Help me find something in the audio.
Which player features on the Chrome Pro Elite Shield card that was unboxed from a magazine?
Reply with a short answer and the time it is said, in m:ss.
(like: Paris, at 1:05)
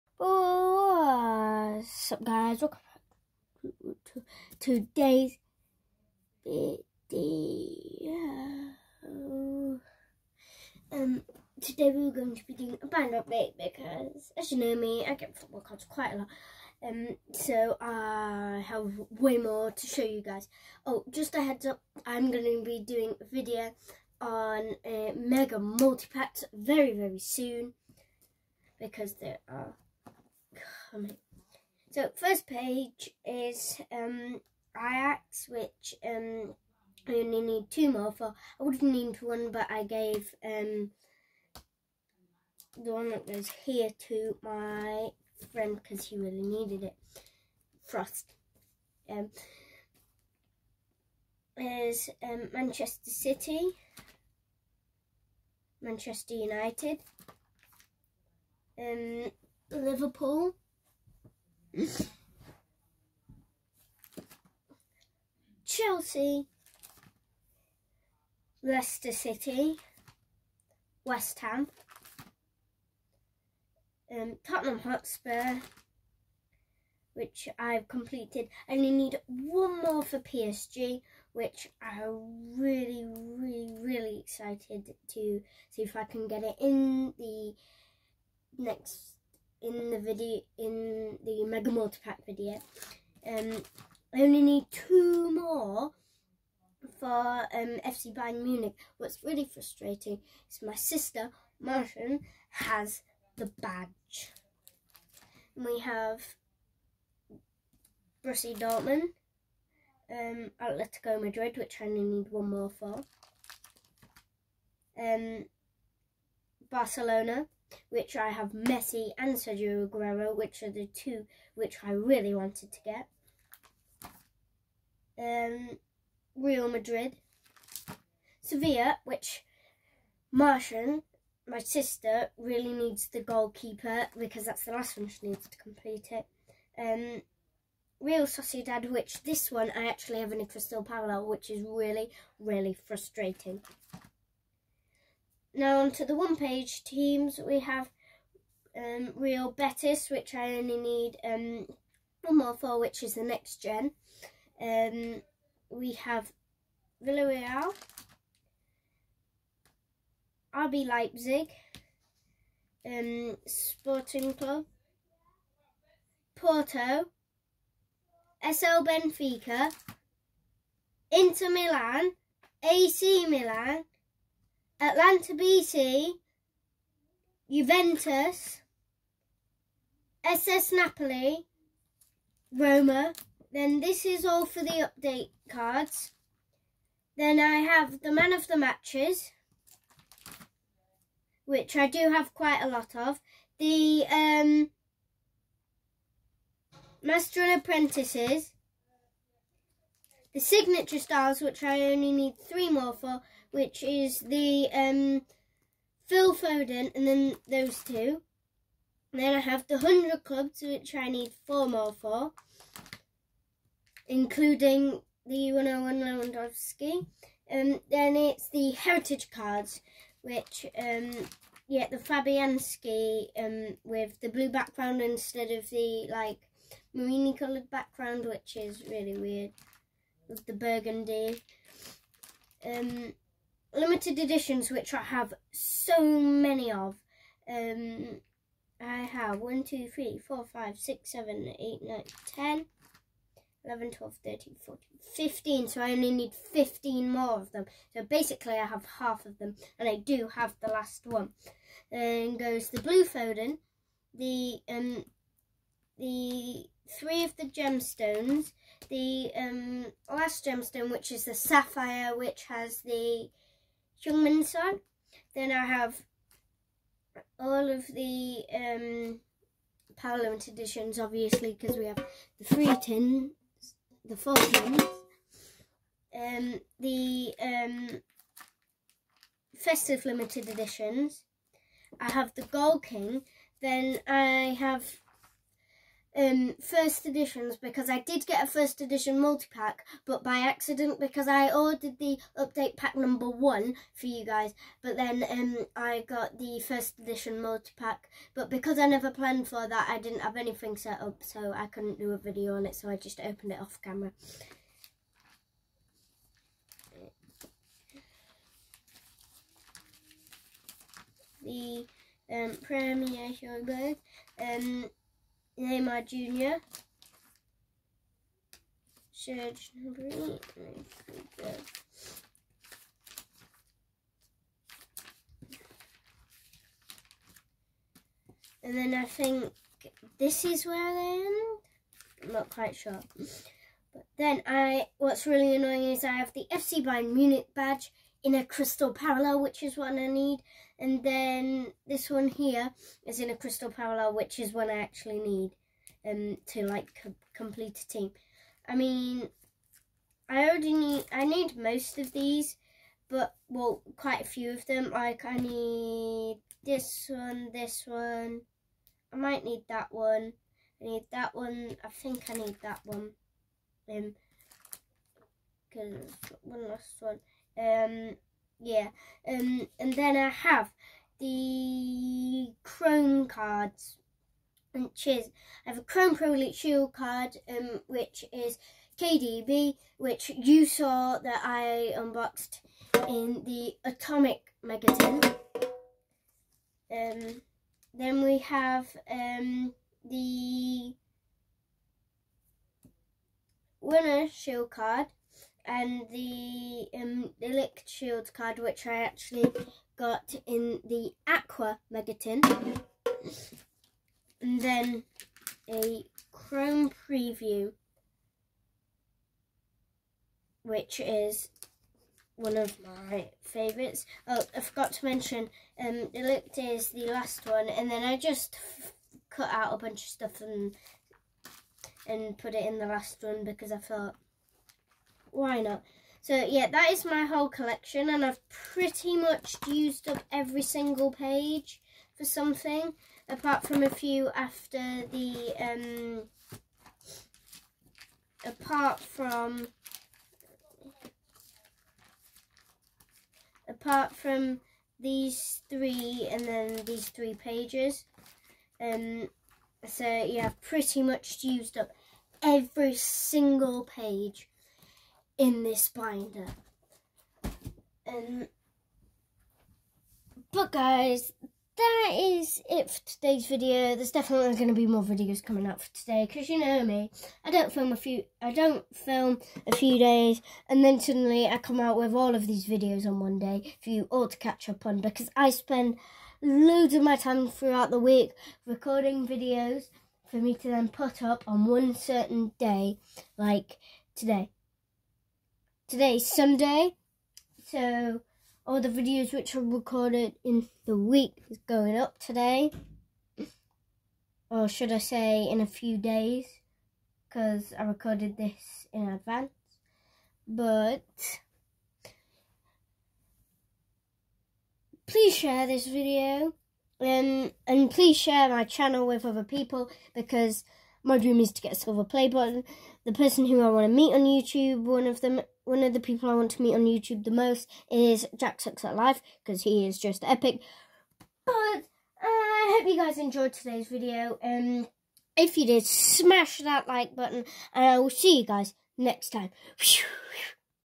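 KDB, at 6:18.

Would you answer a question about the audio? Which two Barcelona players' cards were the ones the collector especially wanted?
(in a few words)
Messi and Sergio Aguero.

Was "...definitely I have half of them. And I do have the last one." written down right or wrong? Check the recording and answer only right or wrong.
wrong.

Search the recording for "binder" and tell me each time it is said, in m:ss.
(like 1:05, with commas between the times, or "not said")
0:12, 7:35.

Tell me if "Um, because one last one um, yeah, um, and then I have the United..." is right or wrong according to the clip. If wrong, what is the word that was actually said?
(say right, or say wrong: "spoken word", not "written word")
wrong: "Chrome", not "United".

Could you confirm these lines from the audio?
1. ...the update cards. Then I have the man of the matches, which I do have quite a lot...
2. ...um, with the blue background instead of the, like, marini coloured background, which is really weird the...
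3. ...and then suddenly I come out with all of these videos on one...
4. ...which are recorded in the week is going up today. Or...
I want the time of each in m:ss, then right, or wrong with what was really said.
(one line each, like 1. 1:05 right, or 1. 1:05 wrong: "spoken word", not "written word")
1. 3:04 right
2. 3:43 right
3. 7:50 right
4. 8:09 right.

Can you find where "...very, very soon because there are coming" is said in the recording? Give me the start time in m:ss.
0:26.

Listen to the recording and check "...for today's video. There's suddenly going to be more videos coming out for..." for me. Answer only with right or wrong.
wrong.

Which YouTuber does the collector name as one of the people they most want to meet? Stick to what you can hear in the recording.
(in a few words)
Jack Sucks at Life.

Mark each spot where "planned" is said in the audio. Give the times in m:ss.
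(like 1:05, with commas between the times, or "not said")
4:59.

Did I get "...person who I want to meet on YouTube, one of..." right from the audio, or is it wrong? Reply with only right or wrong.
right.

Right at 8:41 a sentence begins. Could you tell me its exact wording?
But uh, I hope you guys enjoyed today's video.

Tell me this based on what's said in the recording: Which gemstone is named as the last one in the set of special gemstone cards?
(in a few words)
sapphire.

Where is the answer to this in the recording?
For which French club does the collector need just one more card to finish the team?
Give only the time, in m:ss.
1:20.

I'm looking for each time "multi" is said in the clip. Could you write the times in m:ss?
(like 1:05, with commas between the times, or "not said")
0:25, 1:31, 4:49, 4:57.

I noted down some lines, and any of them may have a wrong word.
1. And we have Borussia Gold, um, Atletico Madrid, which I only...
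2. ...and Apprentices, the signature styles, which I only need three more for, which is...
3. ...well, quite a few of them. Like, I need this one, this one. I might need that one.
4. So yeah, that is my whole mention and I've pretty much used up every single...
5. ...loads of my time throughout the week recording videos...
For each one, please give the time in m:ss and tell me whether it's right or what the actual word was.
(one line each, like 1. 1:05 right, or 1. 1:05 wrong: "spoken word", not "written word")
1. 1:45 wrong: "Dortmund", not "Gold"
2. 3:17 right
3. 5:53 right
4. 7:06 wrong: "collection", not "mention"
5. 7:56 right.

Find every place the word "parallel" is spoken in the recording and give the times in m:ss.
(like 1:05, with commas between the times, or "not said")
2:20, 5:38, 5:43.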